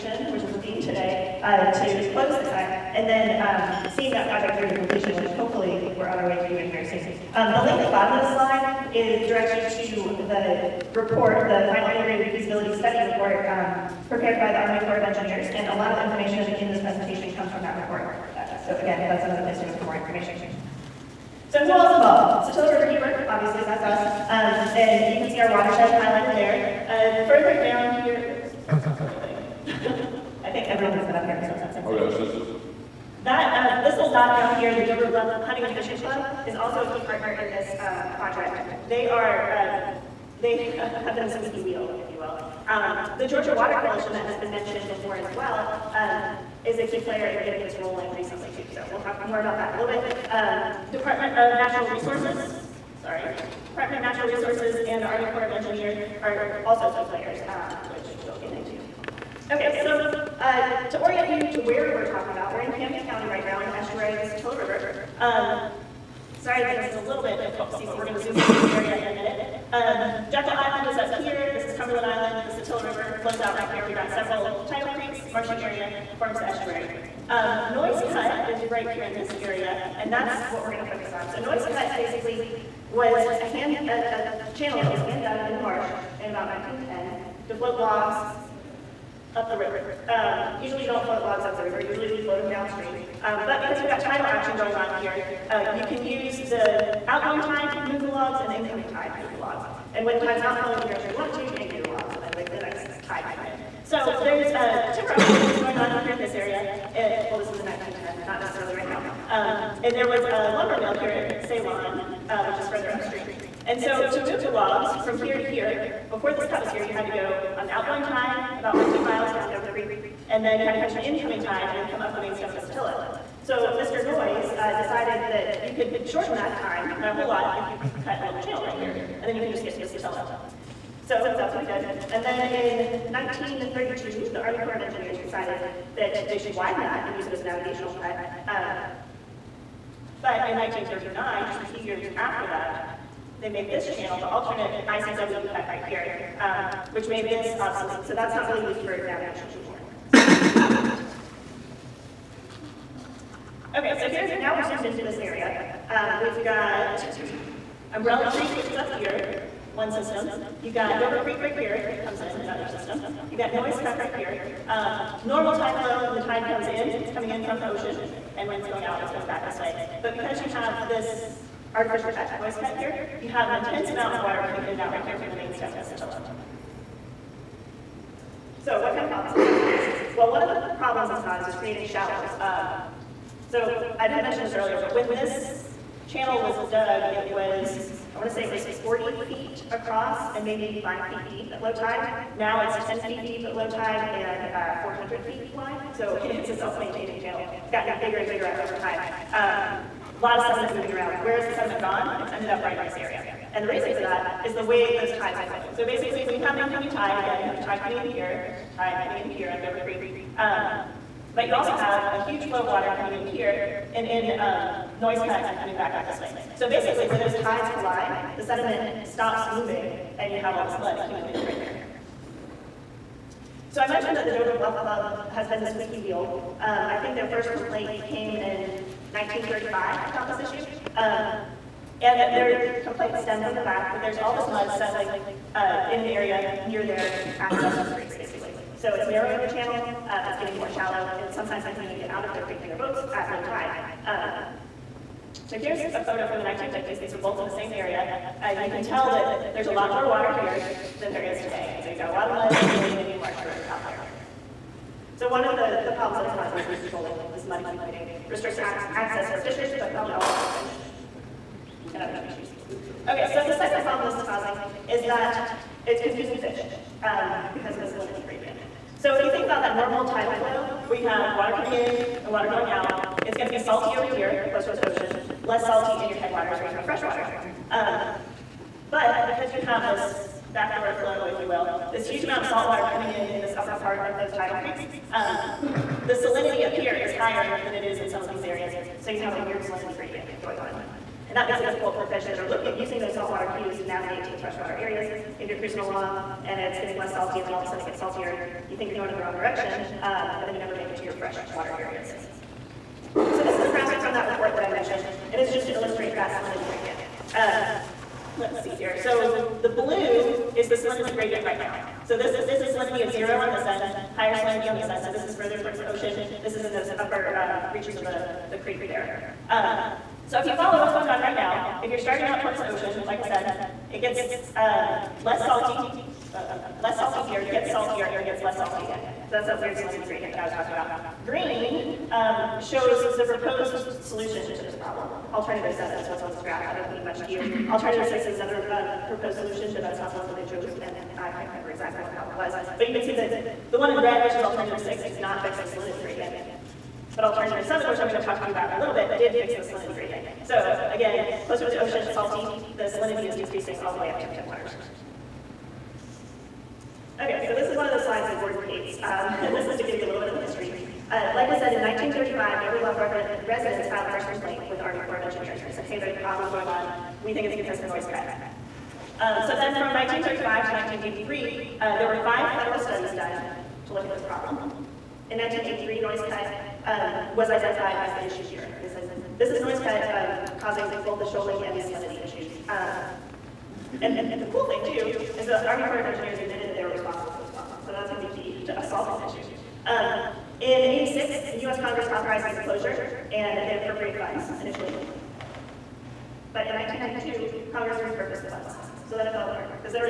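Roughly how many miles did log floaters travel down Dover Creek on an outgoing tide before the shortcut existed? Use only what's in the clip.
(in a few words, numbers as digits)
15.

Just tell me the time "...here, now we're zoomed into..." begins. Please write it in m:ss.
2:34.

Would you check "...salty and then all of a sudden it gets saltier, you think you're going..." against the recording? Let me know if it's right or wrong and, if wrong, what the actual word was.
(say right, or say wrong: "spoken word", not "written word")
right.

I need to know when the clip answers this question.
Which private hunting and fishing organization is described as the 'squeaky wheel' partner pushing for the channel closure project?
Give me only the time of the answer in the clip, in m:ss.
0:34.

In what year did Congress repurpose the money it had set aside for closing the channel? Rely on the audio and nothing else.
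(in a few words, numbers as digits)
1992.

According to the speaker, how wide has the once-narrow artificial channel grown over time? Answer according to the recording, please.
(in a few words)
400 feet.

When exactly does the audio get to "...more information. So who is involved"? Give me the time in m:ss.
0:19.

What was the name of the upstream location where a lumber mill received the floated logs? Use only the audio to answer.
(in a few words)
Ceylon.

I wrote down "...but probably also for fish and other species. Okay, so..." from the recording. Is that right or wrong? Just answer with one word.
right.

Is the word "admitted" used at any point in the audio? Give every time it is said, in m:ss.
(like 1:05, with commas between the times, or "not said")
6:26.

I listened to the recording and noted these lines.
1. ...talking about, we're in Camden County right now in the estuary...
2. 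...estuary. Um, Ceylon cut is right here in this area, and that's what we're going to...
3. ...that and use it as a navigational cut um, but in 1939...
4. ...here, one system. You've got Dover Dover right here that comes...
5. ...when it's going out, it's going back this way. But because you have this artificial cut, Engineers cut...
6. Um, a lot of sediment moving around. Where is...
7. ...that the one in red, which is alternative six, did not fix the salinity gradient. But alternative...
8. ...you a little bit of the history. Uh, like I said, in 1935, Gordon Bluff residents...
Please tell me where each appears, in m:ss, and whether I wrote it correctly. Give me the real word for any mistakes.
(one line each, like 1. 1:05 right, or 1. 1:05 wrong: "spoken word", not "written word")
1. 1:02 right
2. 1:16 wrong: "Noyes", not "Ceylon"
3. 2:16 right
4. 2:38 wrong: "Creek", not "Dover"
5. 2:48 wrong: "Noyes", not "Engineers"
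6. 3:19 right
7. 5:43 right
8. 5:59 wrong: "Dover", not "Gordon".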